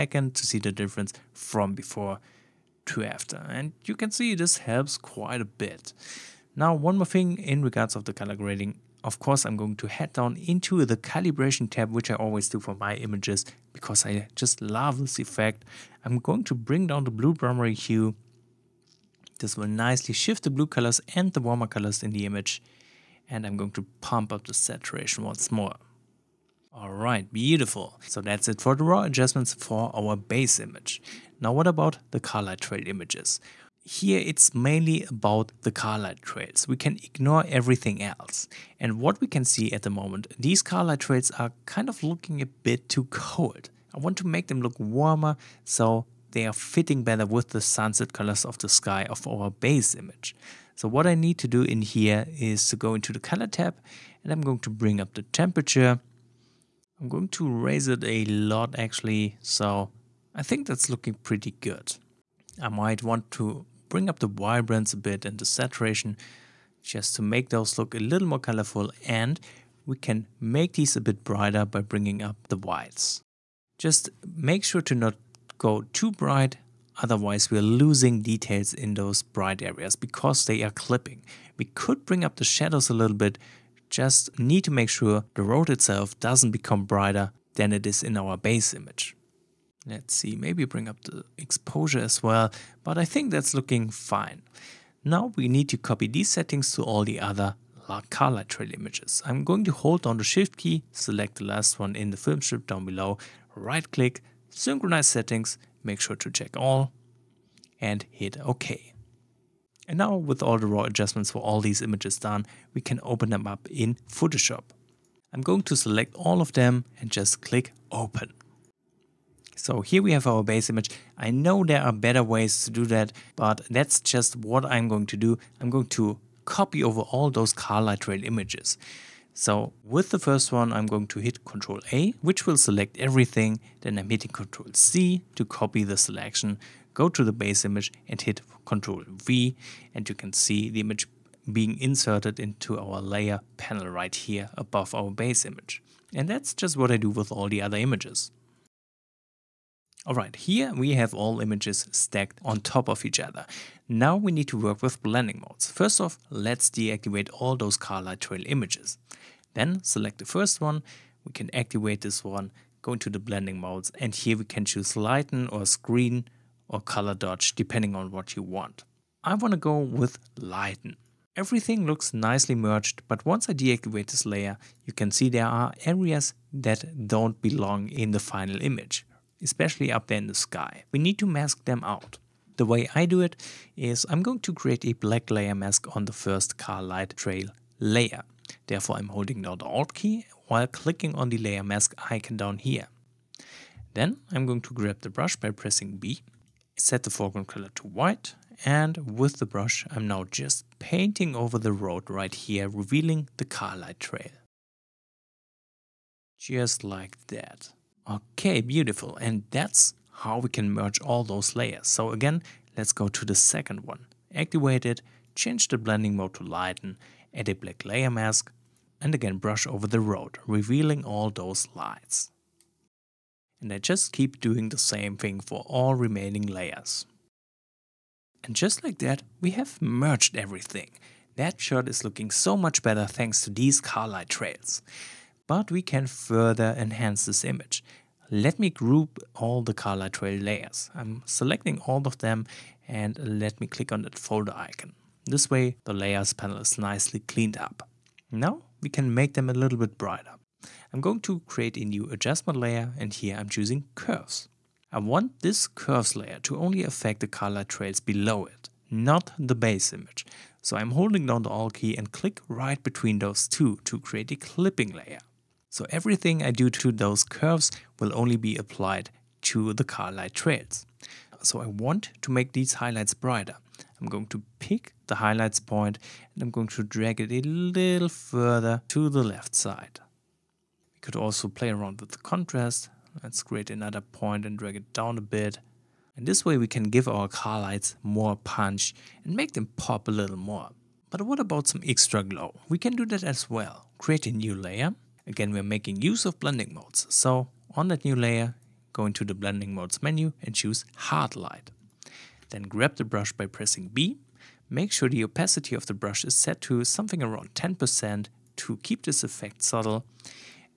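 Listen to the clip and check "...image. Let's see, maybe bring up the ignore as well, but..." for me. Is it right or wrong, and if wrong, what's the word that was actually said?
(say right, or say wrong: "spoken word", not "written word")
wrong: "exposure", not "ignore".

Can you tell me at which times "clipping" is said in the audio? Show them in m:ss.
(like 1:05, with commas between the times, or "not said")
1:20, 4:24.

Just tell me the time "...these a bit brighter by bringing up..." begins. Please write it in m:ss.
1:10.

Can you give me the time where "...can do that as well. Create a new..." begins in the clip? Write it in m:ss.
4:52.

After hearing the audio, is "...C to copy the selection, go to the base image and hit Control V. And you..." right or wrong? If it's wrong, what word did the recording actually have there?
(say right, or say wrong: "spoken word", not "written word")
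right.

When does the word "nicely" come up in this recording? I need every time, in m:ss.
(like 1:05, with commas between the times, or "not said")
0:19, 2:52, 4:06.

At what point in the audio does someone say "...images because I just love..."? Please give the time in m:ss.
0:12.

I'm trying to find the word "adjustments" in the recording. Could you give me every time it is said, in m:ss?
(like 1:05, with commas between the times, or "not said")
0:29, 1:50, 4:12.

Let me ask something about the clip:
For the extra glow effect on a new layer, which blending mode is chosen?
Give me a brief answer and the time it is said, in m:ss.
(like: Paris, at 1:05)
Hard light, at 5:00.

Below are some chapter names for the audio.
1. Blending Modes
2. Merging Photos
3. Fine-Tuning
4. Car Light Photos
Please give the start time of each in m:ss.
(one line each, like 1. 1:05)
1. 2:30
2. 1:58
3. 3:54
4. 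0:30.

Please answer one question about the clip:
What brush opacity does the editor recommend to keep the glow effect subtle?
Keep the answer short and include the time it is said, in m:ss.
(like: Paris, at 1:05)
10%, at 5:07.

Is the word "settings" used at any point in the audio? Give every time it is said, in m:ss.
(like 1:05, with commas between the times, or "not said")
1:36, 1:45.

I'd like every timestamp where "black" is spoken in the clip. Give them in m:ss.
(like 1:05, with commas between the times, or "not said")
3:04, 3:37.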